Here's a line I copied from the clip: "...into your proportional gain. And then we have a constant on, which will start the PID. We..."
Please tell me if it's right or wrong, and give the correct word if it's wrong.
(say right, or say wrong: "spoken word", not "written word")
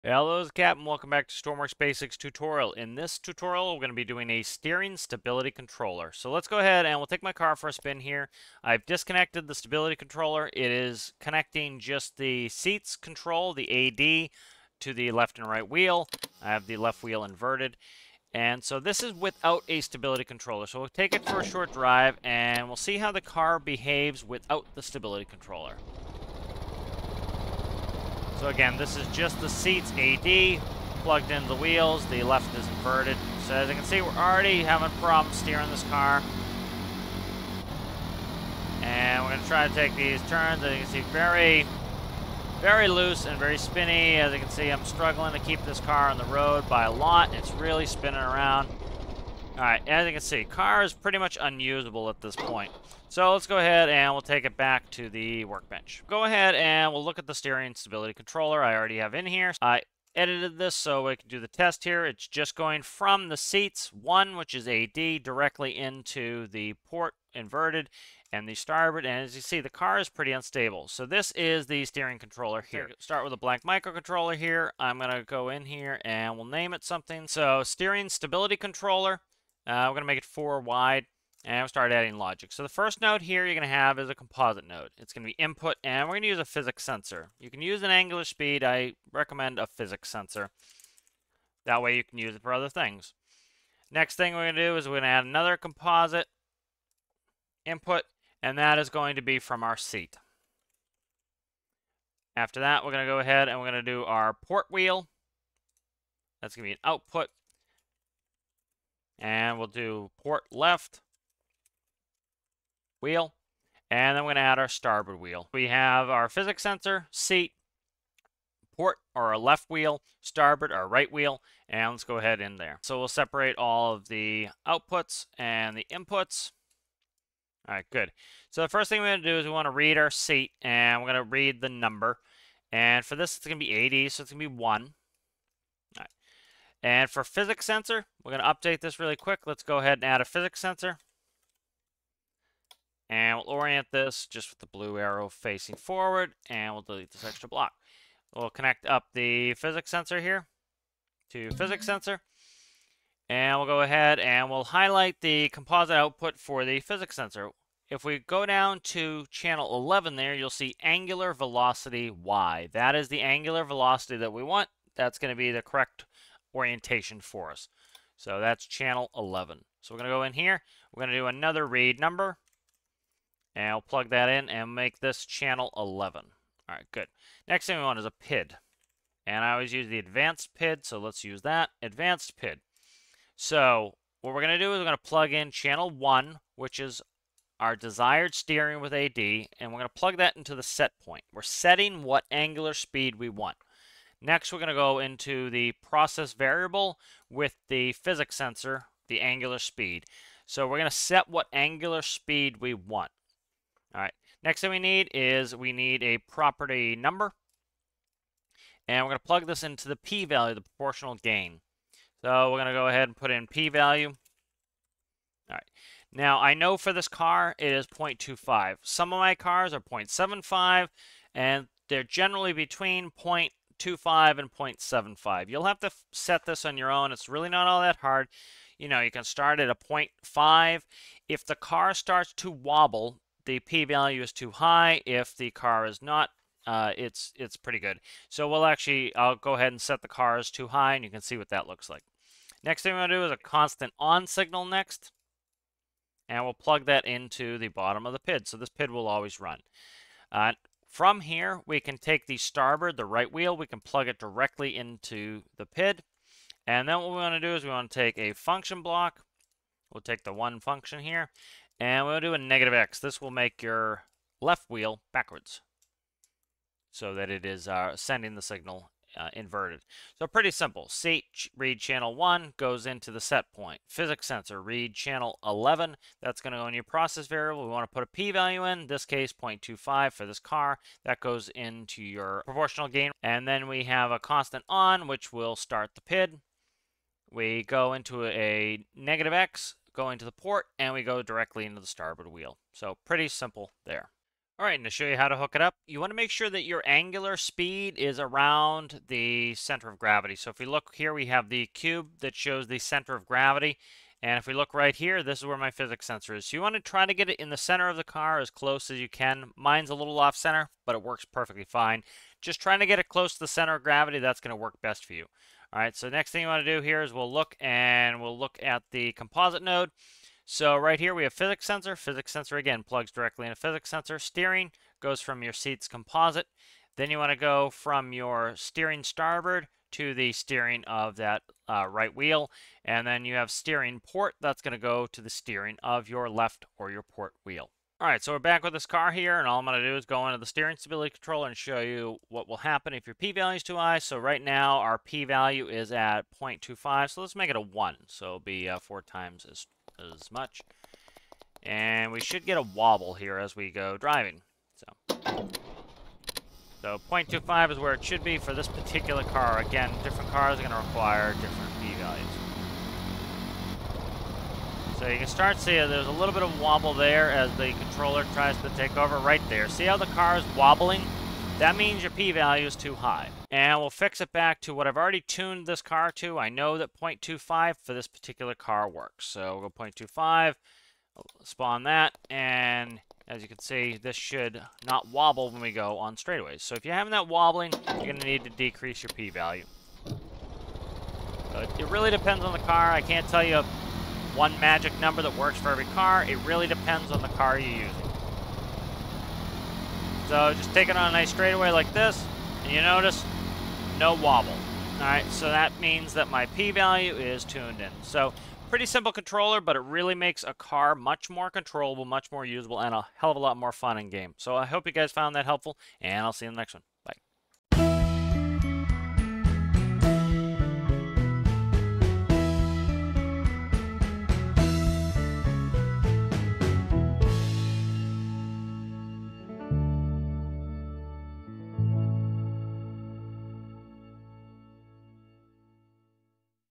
right.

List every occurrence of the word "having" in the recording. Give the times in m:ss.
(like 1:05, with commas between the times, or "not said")
0:34, 6:26.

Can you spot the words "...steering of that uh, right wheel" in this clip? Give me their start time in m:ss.
5:30.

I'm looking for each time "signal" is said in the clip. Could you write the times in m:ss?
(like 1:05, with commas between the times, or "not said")
4:04, 4:28.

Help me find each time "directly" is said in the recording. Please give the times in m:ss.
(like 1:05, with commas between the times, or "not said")
1:05, 4:14, 4:51, 5:23.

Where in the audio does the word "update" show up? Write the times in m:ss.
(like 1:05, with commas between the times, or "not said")
2:18.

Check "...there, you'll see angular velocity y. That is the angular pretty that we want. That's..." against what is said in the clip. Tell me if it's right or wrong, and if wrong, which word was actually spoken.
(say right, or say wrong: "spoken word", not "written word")
wrong: "velocity", not "pretty".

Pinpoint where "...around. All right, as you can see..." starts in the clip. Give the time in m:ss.
0:48.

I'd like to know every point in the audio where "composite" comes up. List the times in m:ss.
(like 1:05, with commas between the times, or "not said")
1:24, 1:35, 2:35, 5:19, 5:25.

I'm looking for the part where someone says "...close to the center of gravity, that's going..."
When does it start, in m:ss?
5:13.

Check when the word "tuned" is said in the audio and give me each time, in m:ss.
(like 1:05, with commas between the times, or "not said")
6:15, 6:47.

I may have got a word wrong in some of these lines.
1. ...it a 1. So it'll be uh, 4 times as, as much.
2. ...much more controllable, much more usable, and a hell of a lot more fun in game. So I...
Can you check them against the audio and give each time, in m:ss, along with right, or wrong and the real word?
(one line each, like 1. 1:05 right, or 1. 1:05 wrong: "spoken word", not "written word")
1. 5:47 right
2. 6:50 right.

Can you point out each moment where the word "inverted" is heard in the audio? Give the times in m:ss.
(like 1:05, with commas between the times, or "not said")
0:17, 0:32, 1:07, 4:29.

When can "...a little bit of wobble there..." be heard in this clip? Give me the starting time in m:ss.
6:06.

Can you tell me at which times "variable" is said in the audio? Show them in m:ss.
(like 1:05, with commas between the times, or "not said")
3:16, 4:37.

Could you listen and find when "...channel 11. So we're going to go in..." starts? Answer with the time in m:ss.
2:48.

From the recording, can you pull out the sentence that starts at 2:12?
And for this, it's going to be AD, so it's going to be 1.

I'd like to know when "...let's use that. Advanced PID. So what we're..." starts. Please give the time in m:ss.
3:00.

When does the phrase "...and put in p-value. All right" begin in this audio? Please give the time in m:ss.
3:33.